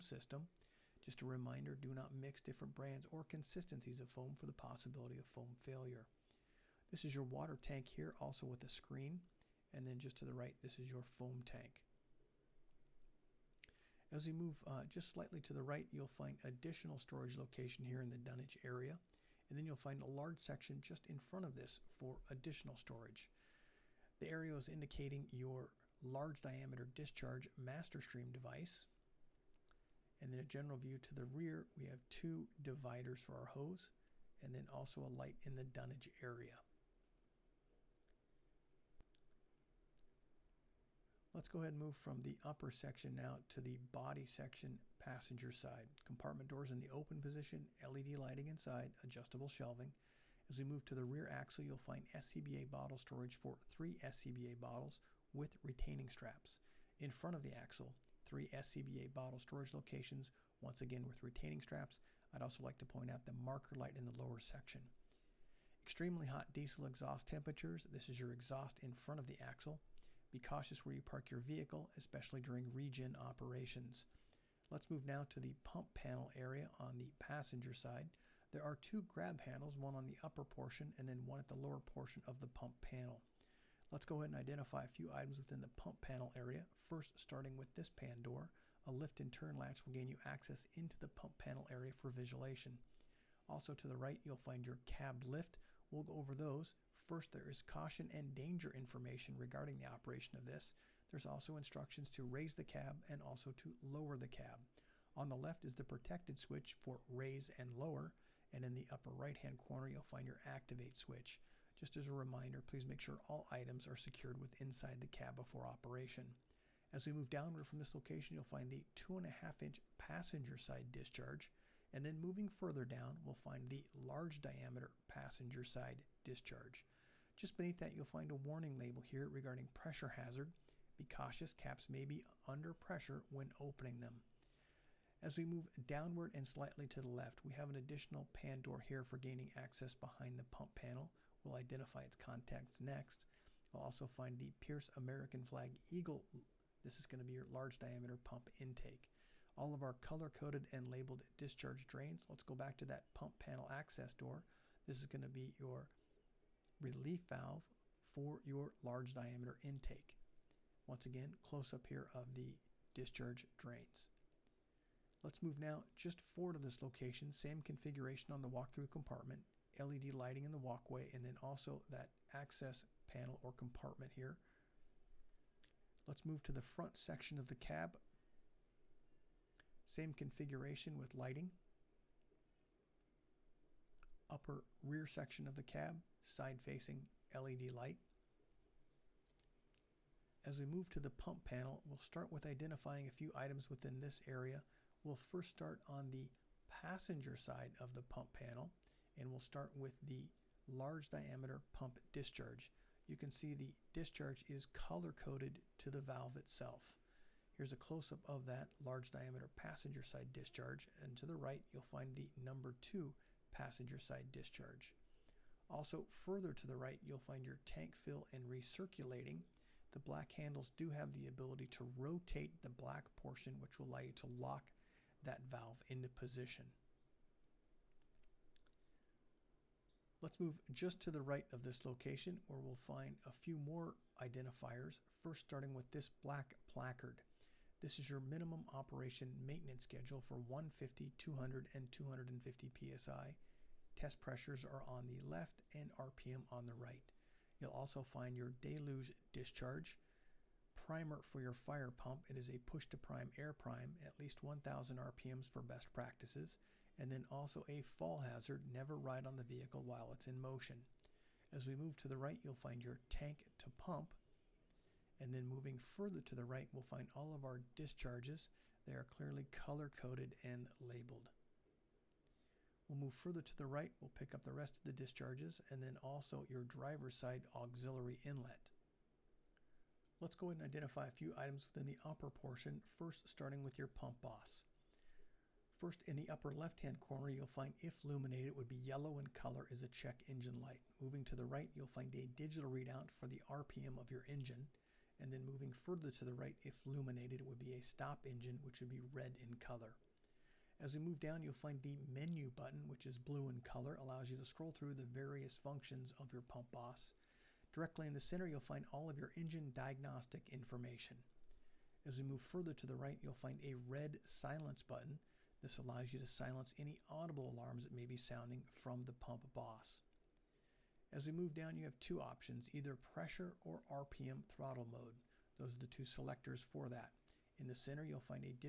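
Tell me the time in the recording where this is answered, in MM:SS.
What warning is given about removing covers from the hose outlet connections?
02:11.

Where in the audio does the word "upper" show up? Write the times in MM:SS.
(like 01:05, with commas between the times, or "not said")
00:42, 01:20, 01:48, 03:04, 04:42, 04:46.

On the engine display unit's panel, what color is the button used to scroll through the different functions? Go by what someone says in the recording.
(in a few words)
Blue.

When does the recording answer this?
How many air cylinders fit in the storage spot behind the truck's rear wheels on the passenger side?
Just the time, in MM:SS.
00:53.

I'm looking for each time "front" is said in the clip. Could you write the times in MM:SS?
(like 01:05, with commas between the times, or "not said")
00:21, 00:57, 01:08, 02:56.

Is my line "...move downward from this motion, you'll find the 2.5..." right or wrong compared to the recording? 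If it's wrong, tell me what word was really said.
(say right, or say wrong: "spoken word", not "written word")
wrong: "location", not "motion".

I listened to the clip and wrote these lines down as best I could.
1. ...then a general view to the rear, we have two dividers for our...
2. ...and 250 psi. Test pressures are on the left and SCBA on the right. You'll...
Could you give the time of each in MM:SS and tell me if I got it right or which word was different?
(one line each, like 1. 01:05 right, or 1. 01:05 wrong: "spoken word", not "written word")
1. 00:30 right
2. 04:01 wrong: "RPM", not "SCBA".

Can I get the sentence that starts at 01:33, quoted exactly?
Also to the right, you'll find your cab lift.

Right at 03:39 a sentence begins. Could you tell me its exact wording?
The black handles do have the ability to rotate the black portion which will allow you to lock that valve into position.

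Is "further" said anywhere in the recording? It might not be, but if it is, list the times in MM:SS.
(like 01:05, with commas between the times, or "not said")
02:02, 03:36, 04:25, 04:33, 04:55, 05:12.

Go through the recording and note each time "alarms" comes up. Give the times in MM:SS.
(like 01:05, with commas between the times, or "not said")
05:17.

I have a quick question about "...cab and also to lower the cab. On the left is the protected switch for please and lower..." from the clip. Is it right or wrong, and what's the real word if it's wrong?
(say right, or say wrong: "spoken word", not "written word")
wrong: "raise", not "please".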